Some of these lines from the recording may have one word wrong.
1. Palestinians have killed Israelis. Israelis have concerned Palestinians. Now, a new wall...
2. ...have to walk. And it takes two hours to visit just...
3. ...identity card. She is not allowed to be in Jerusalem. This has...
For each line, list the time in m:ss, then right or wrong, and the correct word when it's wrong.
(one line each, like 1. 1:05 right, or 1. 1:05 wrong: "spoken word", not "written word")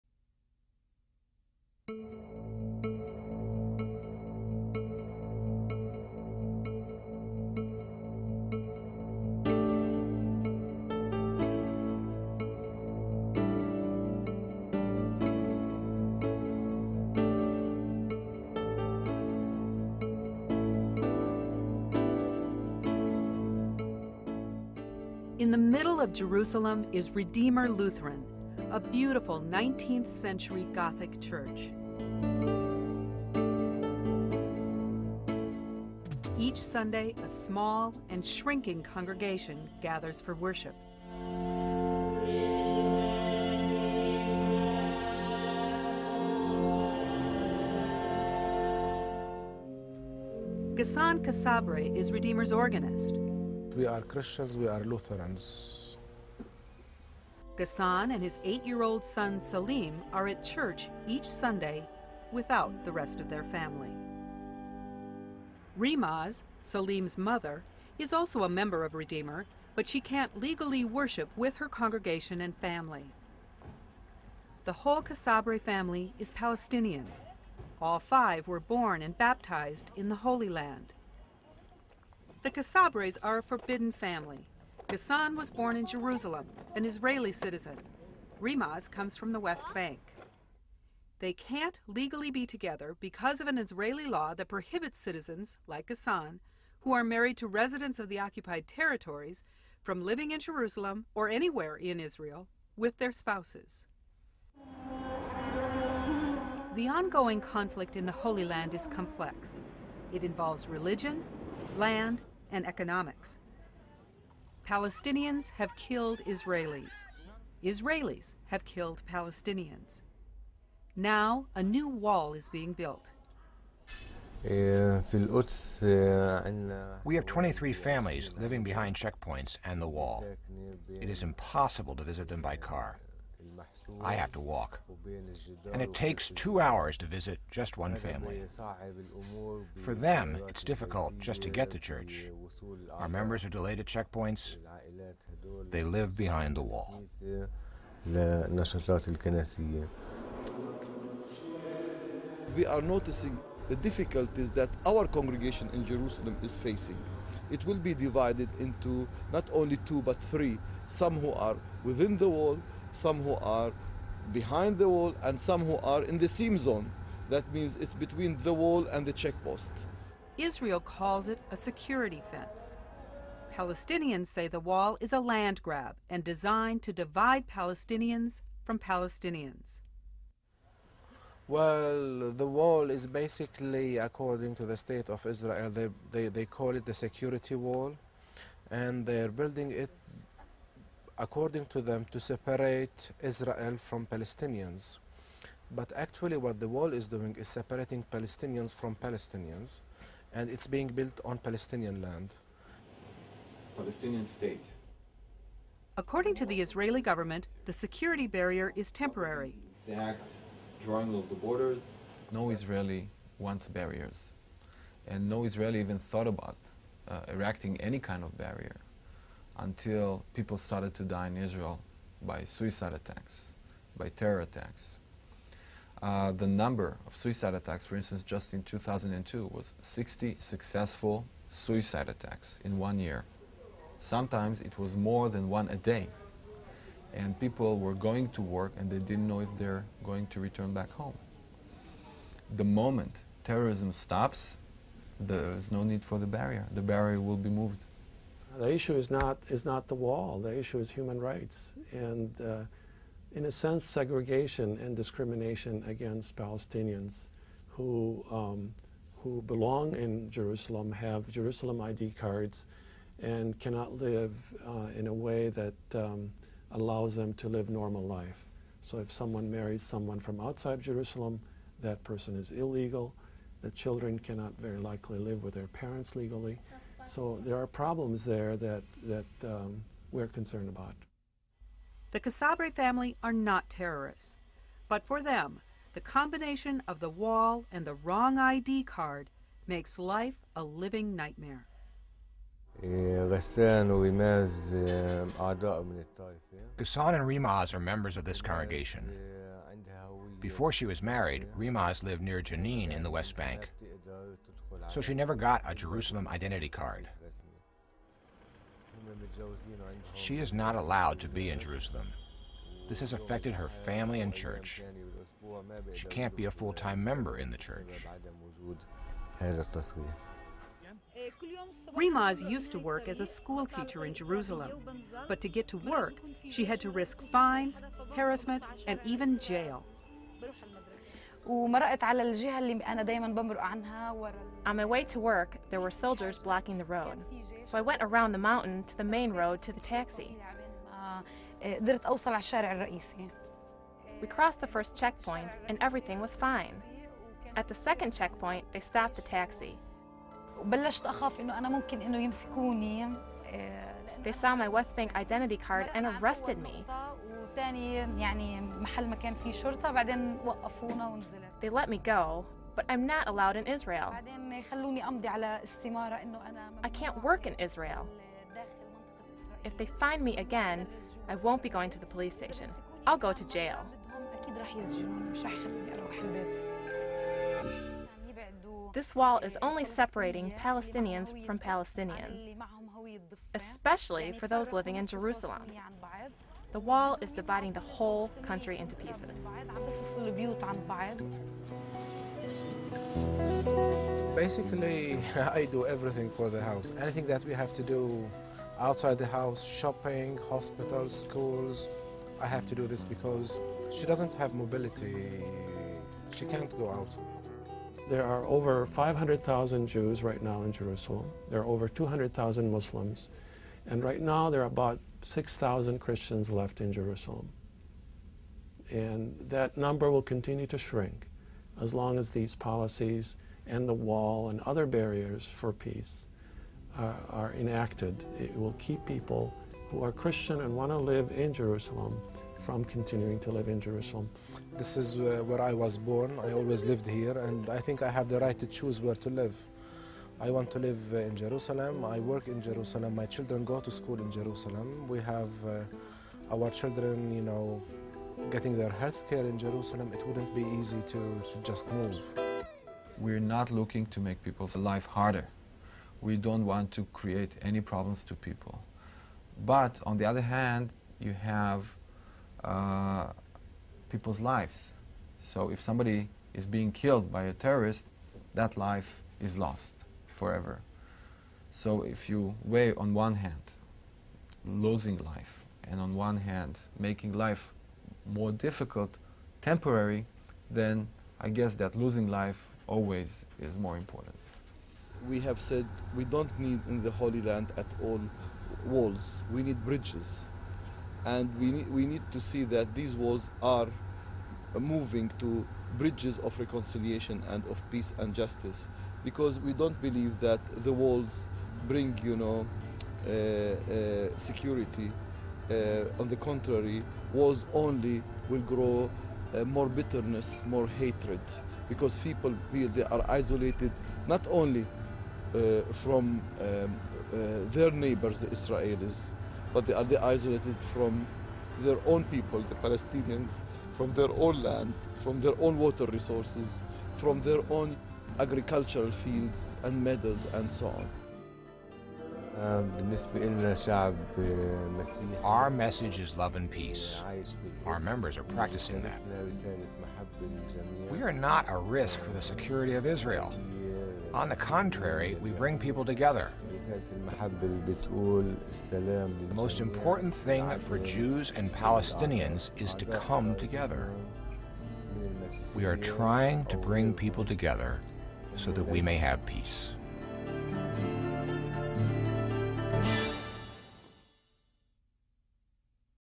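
1. 1:54 wrong: "killed", not "concerned"
2. 2:14 right
3. 5:06 right.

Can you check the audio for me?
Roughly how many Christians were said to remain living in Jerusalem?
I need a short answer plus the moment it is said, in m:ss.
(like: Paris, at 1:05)
6,000, at 6:55.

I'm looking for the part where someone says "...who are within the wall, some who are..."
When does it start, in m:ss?
2:41.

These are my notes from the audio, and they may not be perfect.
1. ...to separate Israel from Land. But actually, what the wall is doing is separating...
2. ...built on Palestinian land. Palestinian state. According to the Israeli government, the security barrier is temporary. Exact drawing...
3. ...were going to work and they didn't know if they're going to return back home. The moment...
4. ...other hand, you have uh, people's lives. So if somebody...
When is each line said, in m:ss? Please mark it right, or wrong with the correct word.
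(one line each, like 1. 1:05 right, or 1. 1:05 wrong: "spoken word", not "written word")
1. 3:12 wrong: "Palestinians", not "Land"
2. 3:20 right
3. 3:57 right
4. 7:40 right.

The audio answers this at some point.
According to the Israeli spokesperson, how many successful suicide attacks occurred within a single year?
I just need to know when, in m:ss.
3:49.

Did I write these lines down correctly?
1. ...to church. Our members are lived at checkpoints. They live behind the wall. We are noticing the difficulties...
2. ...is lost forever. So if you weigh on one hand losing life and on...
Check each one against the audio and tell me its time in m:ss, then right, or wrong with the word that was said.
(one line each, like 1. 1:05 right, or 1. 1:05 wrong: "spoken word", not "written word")
1. 2:21 wrong: "delayed", not "lived"
2. 7:49 right.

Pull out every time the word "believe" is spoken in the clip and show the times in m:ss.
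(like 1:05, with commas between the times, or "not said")
8:20.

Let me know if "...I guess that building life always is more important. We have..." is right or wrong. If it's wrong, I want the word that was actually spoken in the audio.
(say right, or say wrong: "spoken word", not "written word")
wrong: "losing", not "building".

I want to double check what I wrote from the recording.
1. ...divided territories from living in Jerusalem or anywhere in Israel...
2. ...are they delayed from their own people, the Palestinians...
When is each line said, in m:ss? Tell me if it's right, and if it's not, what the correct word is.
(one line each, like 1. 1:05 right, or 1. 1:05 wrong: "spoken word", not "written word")
1. 1:38 wrong: "occupied", not "divided"
2. 8:39 wrong: "isolated", not "delayed".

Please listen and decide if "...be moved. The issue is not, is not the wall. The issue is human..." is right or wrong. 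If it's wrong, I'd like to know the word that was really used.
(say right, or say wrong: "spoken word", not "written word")
right.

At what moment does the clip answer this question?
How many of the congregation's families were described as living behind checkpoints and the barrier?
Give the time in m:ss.
2:07.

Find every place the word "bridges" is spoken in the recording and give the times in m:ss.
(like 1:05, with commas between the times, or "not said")
8:09, 8:15.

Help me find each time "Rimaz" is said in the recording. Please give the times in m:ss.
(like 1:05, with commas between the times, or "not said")
1:05, 1:28, 4:57, 5:01, 5:21.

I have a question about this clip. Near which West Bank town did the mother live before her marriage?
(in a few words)
Jenin.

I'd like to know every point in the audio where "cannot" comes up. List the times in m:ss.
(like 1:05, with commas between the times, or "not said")
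4:23, 4:34.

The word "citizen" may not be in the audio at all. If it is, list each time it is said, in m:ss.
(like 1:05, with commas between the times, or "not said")
1:27, 1:34.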